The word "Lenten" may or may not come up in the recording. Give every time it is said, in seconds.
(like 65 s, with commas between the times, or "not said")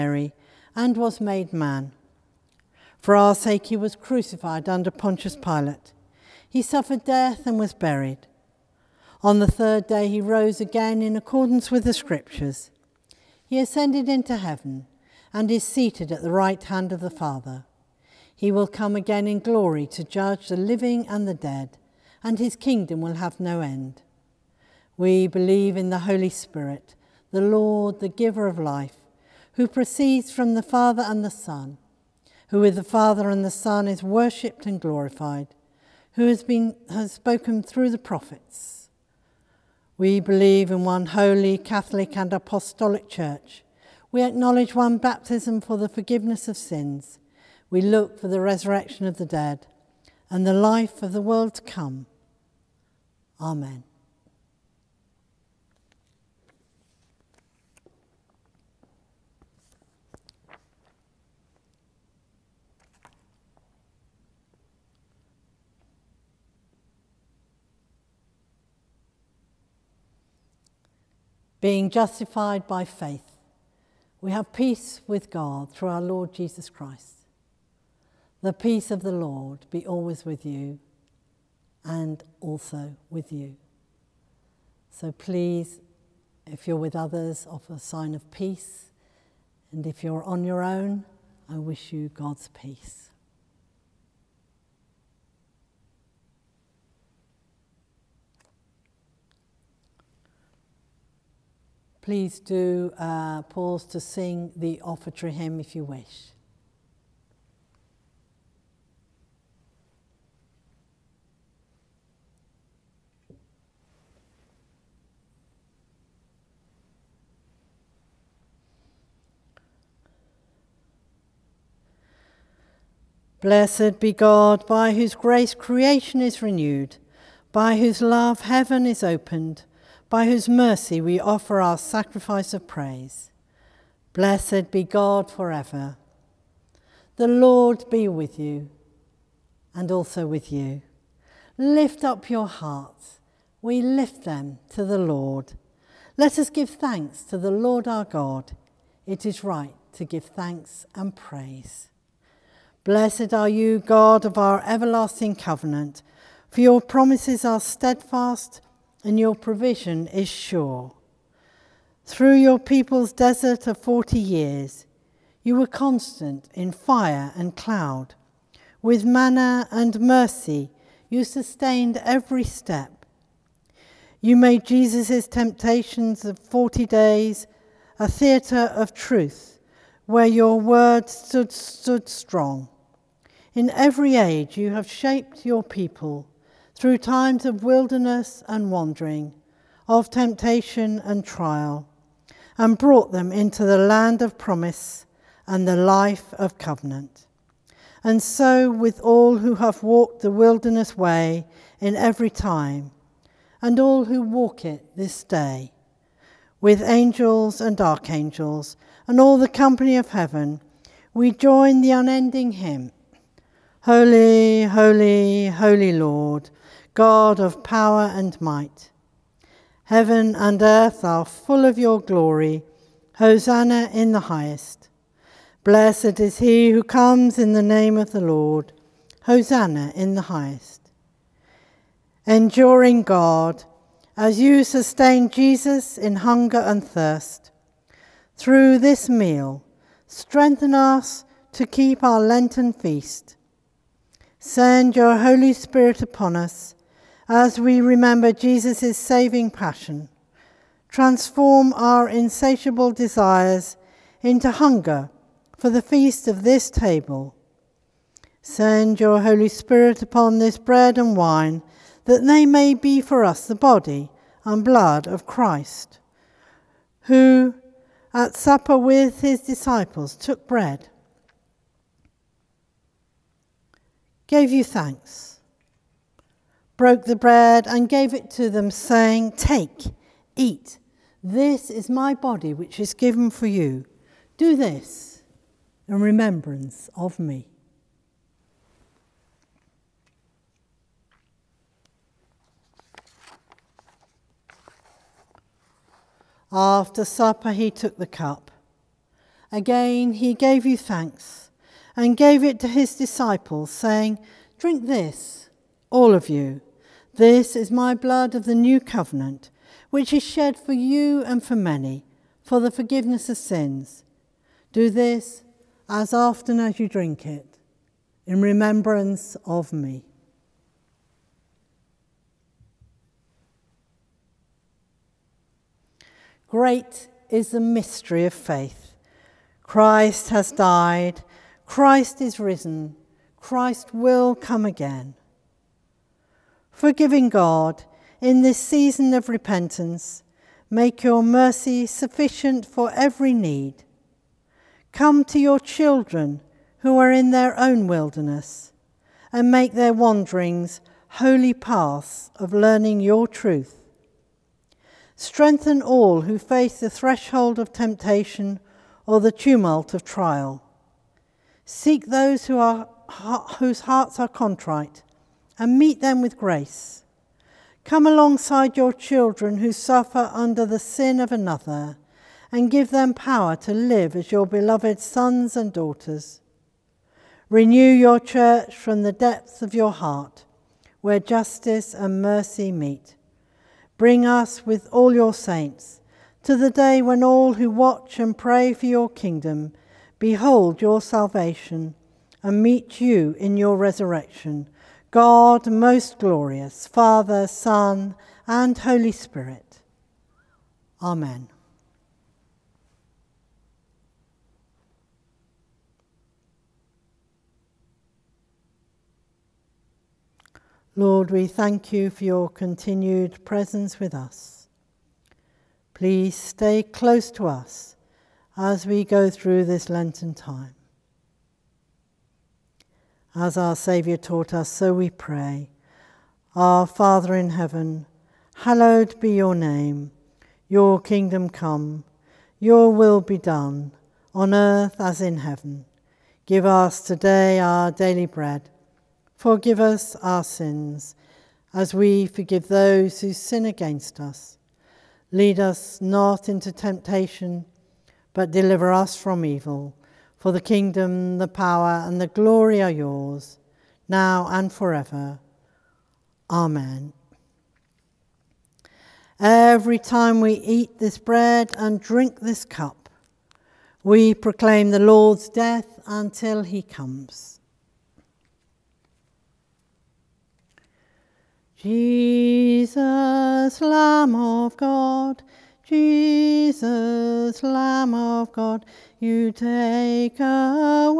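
242 s, 419 s.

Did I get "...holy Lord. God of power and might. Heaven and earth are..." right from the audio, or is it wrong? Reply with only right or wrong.
right.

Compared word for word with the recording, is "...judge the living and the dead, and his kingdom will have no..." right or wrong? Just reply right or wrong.
right.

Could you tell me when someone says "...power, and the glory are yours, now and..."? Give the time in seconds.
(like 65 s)
451 s.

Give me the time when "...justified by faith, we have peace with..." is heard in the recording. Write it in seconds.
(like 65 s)
71 s.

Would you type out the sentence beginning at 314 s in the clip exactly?
Do this as often as you drink it, in remembrance of me.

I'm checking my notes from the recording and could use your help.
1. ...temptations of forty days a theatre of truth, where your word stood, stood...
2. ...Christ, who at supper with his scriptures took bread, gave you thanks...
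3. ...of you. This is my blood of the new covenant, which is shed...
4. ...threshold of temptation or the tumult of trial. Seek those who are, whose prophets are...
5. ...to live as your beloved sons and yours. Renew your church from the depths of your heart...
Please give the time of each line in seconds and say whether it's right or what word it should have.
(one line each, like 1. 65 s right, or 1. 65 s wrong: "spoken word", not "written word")
1. 175 s right
2. 265 s wrong: "disciples", not "scriptures"
3. 306 s right
4. 356 s wrong: "hearts", not "prophets"
5. 373 s wrong: "daughters", not "yours".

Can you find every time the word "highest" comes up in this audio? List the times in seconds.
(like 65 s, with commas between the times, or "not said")
224 s, 230 s.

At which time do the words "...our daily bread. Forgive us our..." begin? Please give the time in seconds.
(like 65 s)
437 s.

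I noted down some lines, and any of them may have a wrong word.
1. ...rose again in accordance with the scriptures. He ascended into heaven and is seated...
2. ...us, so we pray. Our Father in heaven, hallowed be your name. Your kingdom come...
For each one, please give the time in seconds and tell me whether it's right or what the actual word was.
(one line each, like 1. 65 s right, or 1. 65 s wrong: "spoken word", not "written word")
1. 10 s right
2. 424 s right.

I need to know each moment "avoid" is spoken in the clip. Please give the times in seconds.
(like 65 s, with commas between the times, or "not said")
not said.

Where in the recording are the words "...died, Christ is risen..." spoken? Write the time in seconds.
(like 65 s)
330 s.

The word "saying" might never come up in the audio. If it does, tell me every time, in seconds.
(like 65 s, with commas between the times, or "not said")
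278 s, 303 s.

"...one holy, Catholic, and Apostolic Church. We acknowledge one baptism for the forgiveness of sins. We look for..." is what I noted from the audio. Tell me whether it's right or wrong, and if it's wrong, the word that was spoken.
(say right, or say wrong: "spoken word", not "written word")
right.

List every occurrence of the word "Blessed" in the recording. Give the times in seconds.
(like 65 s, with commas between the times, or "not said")
123 s, 134 s, 152 s, 225 s.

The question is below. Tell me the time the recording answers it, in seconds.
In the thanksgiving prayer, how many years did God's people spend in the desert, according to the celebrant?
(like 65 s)
163 s.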